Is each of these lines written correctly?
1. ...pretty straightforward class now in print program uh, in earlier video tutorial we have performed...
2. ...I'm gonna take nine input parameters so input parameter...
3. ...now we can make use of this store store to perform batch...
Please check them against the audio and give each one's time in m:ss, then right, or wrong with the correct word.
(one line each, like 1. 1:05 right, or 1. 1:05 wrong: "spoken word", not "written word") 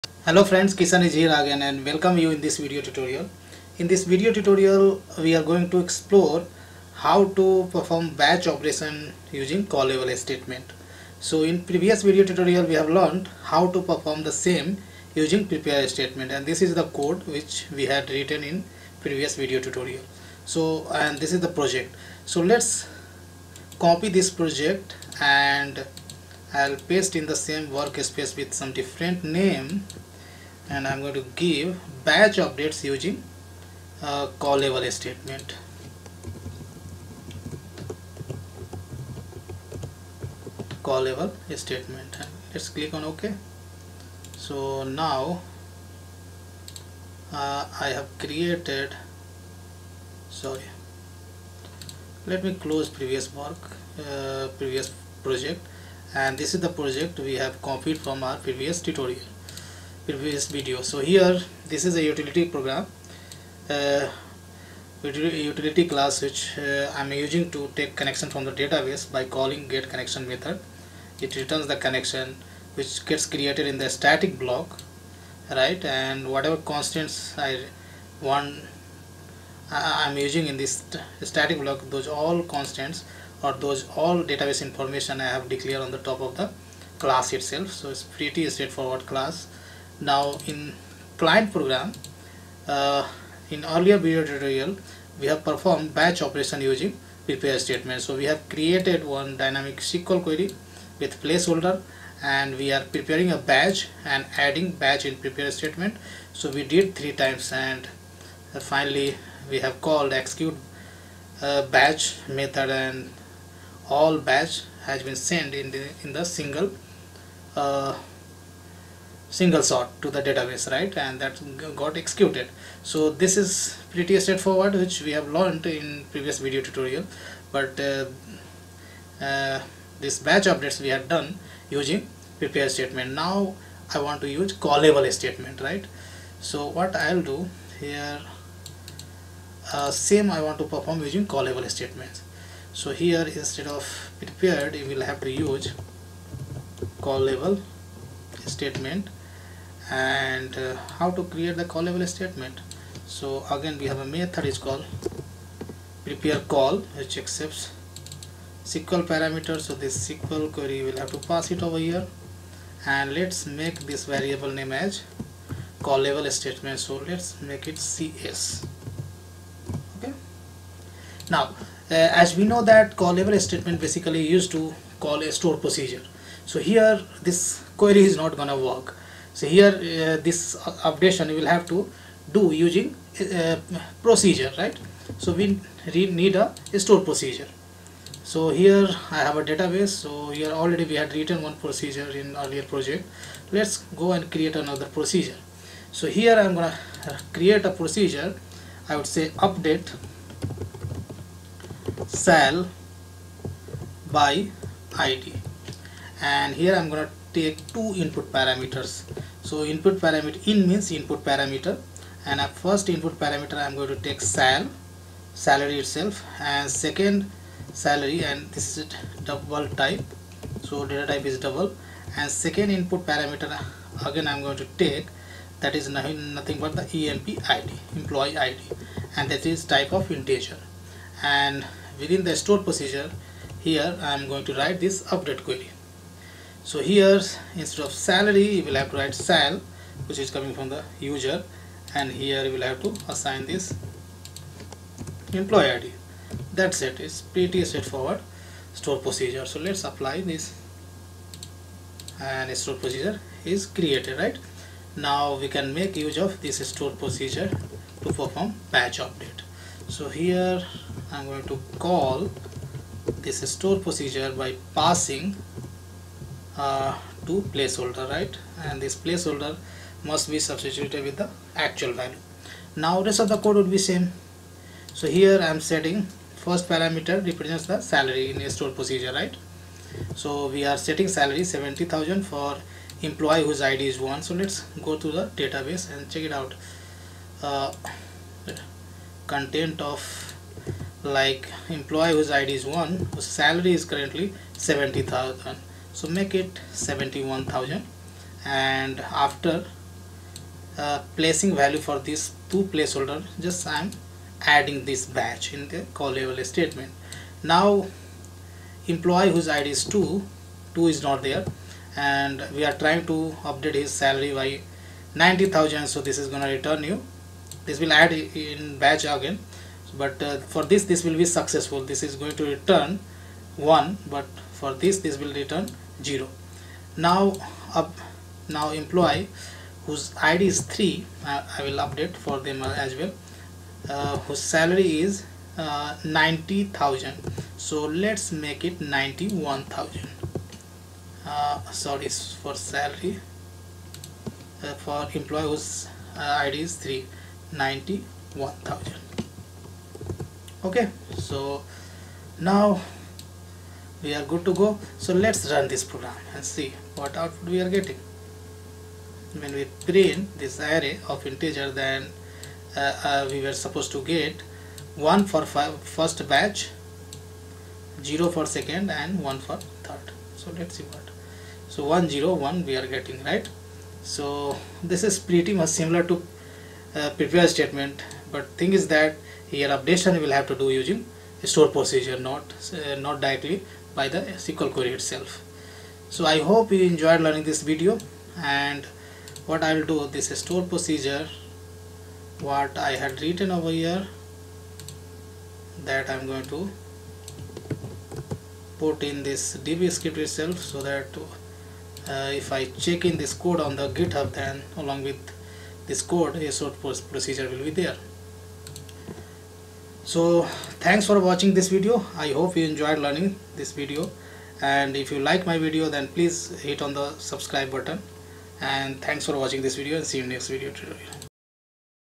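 1. 1:28 wrong: "client", not "print"
2. 3:26 wrong: "two", not "nine"
3. 4:14 wrong: "procedure", not "store".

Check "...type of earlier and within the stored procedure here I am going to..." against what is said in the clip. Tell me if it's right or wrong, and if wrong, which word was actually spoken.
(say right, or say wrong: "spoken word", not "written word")
wrong: "integer", not "earlier".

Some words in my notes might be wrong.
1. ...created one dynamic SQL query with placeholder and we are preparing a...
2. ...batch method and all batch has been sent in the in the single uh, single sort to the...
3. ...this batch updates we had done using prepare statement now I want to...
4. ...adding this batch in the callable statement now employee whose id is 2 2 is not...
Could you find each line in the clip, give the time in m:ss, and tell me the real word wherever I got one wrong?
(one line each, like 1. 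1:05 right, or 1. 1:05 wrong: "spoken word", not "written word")
1. 1:38 right
2. 1:51 right
3. 2:10 right
4. 5:04 right.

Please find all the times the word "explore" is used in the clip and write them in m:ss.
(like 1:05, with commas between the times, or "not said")
0:05.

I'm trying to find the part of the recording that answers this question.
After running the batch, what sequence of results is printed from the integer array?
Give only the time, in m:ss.
6:11.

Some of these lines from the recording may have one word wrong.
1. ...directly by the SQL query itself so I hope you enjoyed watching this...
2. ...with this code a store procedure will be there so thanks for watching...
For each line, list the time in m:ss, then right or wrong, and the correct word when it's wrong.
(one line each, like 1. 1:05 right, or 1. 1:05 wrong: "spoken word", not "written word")
1. 6:23 wrong: "learning", not "watching"
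2. 6:45 right.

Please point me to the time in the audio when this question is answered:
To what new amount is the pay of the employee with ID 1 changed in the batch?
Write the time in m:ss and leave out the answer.
4:56.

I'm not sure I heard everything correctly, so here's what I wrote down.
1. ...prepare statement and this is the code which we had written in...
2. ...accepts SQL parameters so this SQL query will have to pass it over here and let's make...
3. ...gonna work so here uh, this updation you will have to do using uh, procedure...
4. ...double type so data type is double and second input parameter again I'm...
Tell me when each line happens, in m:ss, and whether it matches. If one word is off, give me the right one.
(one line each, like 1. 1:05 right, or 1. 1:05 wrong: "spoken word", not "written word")
1. 0:15 right
2. 2:37 right
3. 2:58 right
4. 3:39 right.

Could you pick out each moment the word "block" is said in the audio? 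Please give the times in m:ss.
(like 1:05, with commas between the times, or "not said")
1:14, 1:21.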